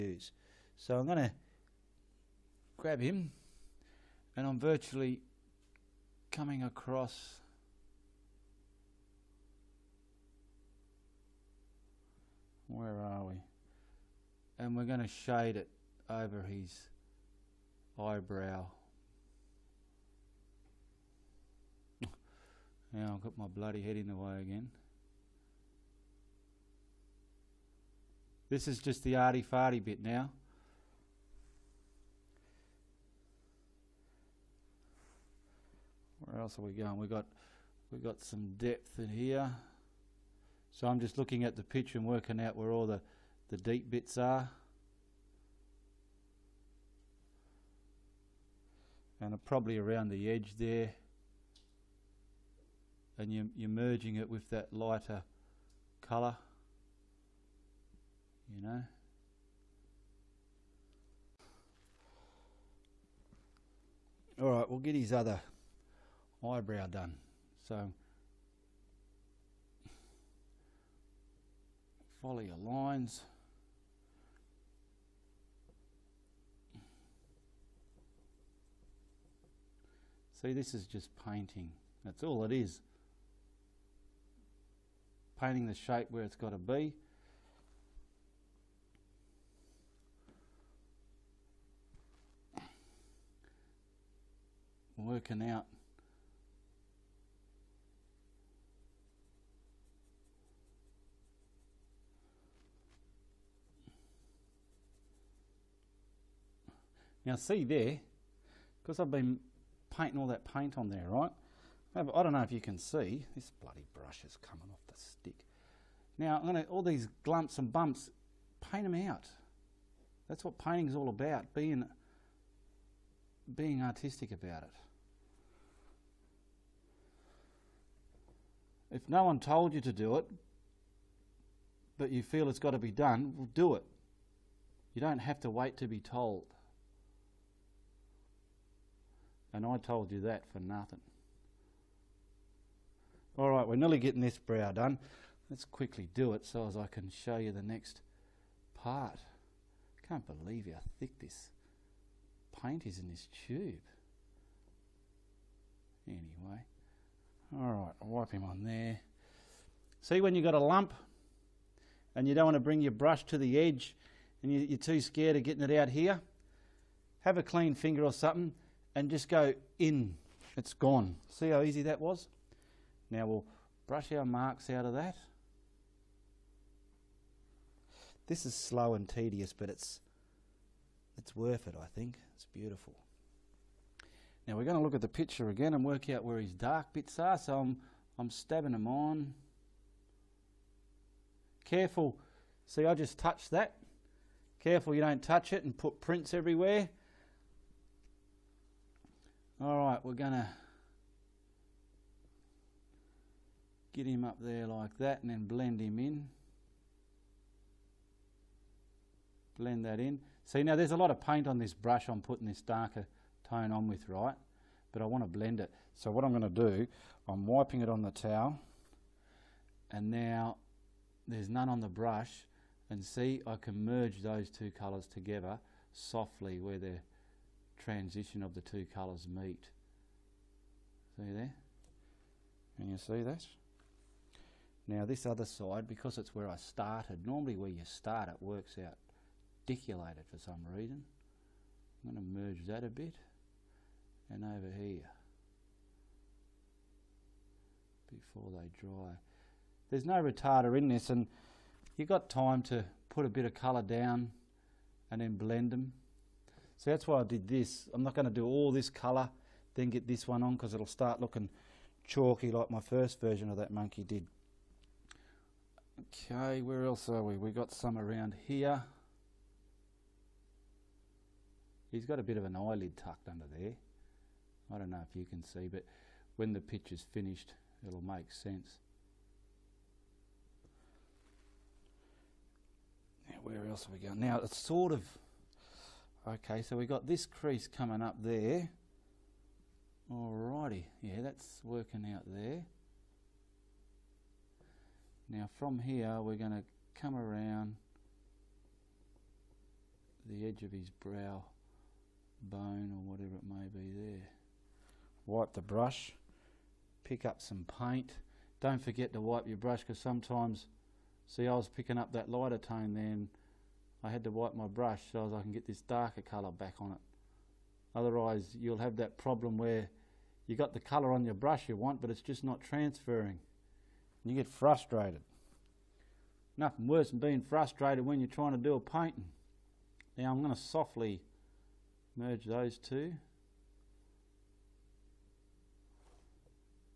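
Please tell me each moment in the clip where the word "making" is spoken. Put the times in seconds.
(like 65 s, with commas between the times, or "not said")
not said.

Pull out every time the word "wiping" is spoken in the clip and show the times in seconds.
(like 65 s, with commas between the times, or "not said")
217 s.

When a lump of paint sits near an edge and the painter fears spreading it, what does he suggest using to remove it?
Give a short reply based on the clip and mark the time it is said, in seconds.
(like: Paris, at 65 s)
a clean finger, at 167 s.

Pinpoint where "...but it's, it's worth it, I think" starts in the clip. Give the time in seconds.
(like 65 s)
179 s.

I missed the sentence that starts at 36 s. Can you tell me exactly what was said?
We got we got some depth in here.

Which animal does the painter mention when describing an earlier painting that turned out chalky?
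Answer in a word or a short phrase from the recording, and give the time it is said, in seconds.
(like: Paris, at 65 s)
monkey, at 263 s.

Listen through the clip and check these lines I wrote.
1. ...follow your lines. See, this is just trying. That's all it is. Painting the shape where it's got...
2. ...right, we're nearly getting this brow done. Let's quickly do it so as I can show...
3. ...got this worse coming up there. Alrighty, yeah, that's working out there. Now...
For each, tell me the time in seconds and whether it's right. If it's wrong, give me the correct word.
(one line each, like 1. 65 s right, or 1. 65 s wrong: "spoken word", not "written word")
1. 72 s wrong: "painting", not "trying"
2. 143 s right
3. 286 s wrong: "crease", not "worse".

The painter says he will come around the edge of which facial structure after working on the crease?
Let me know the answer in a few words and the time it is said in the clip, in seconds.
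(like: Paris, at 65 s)
brow bone, at 300 s.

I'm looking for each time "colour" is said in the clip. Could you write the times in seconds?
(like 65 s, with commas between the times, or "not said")
56 s, 224 s, 228 s, 253 s, 258 s, 316 s, 320 s.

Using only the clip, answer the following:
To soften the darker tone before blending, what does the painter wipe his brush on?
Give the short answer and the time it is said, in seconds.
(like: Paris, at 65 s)
the towel, at 218 s.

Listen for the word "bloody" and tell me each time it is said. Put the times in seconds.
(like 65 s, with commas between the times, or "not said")
23 s, 113 s.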